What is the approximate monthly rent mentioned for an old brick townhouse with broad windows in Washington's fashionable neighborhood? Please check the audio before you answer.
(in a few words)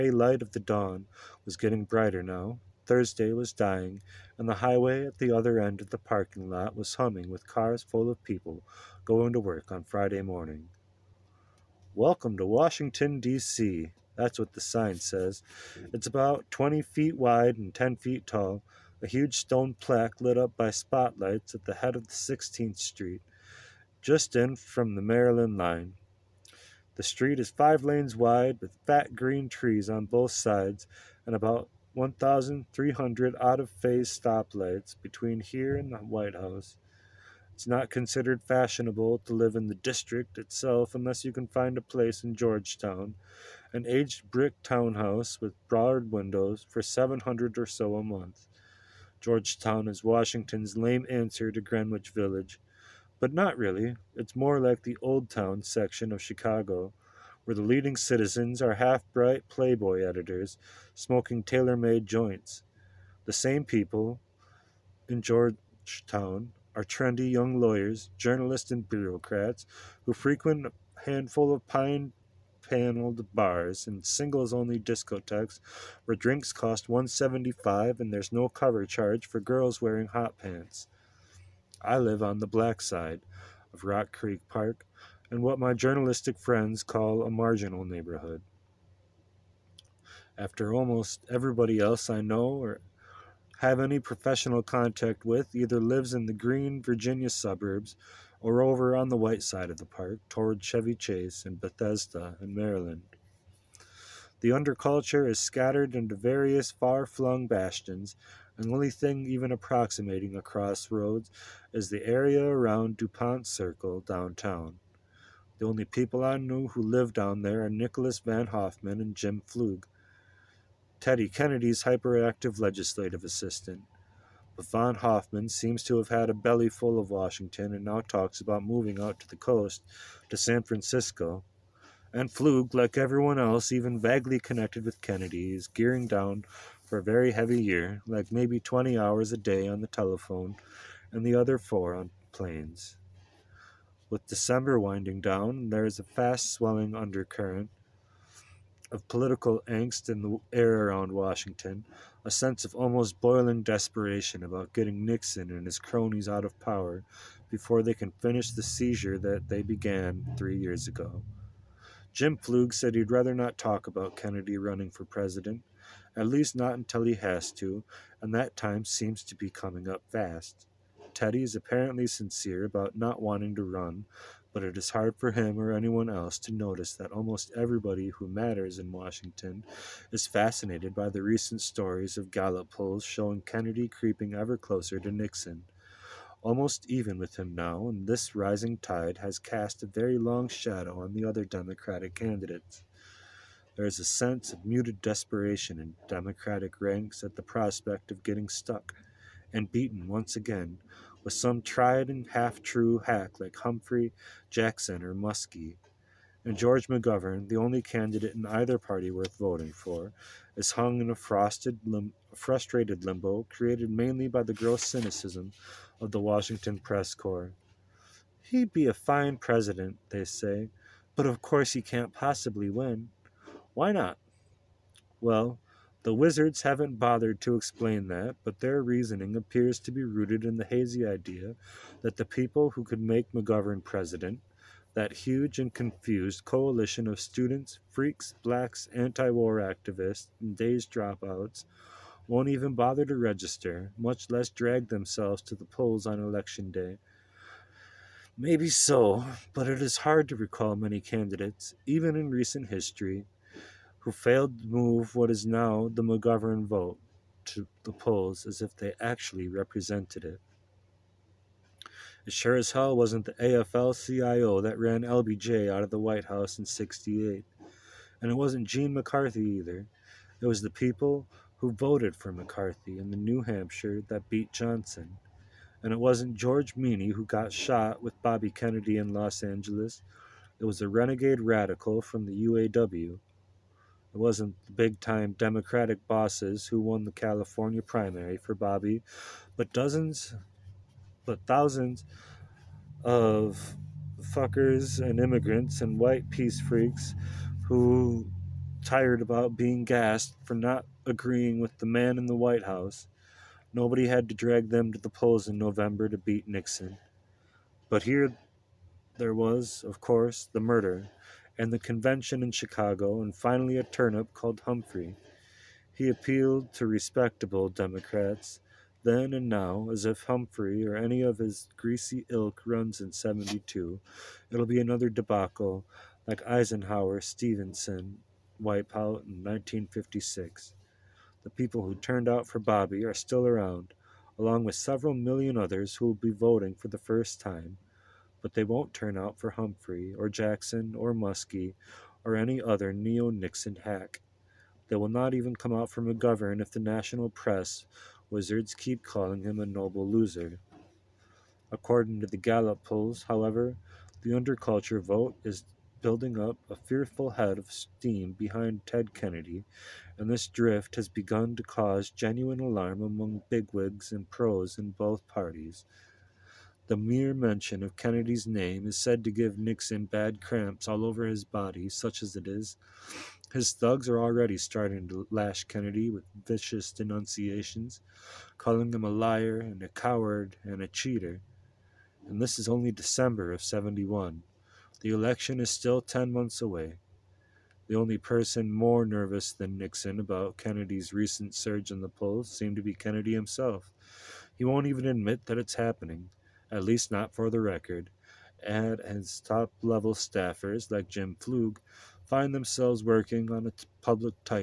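700.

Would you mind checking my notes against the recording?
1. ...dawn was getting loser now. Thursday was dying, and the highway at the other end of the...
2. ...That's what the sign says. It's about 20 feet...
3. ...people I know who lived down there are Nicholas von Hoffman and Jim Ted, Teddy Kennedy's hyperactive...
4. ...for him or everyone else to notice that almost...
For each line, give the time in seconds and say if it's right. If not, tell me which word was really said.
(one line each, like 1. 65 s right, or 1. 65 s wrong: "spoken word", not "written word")
1. 0 s wrong: "brighter", not "loser"
2. 14 s right
3. 115 s wrong: "Flug", not "Ted"
4. 175 s wrong: "anyone", not "everyone".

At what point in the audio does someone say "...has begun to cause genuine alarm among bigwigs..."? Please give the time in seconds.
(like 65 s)
360 s.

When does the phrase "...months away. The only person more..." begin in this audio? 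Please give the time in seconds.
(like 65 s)
386 s.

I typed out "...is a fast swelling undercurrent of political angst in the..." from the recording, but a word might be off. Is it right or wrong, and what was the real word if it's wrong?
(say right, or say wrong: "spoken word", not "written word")
right.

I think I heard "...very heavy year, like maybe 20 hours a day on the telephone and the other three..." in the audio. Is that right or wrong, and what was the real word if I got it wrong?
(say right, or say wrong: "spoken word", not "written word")
wrong: "four", not "three".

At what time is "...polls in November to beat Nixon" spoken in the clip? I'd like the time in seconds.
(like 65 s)
305 s.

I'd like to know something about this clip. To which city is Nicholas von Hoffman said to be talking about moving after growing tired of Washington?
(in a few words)
San Francisco.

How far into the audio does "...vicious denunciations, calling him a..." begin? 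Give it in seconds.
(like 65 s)
376 s.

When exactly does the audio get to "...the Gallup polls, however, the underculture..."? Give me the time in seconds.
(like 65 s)
352 s.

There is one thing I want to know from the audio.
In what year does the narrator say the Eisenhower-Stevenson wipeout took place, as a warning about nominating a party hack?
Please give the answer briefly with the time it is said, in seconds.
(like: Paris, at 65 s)
1956, at 329 s.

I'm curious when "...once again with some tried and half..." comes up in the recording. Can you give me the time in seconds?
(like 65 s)
200 s.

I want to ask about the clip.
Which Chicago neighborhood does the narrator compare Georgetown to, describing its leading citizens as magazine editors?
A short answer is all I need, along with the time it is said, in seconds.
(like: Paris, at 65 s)
Old Town, at 55 s.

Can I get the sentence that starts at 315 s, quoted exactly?
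He appealed to respectable Democrats then and now as if Humphrey or any of his greasy ilk runs in 72.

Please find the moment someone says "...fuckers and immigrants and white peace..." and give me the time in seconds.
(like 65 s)
294 s.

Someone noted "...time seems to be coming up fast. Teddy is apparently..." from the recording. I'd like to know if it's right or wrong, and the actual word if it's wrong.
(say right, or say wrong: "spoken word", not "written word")
right.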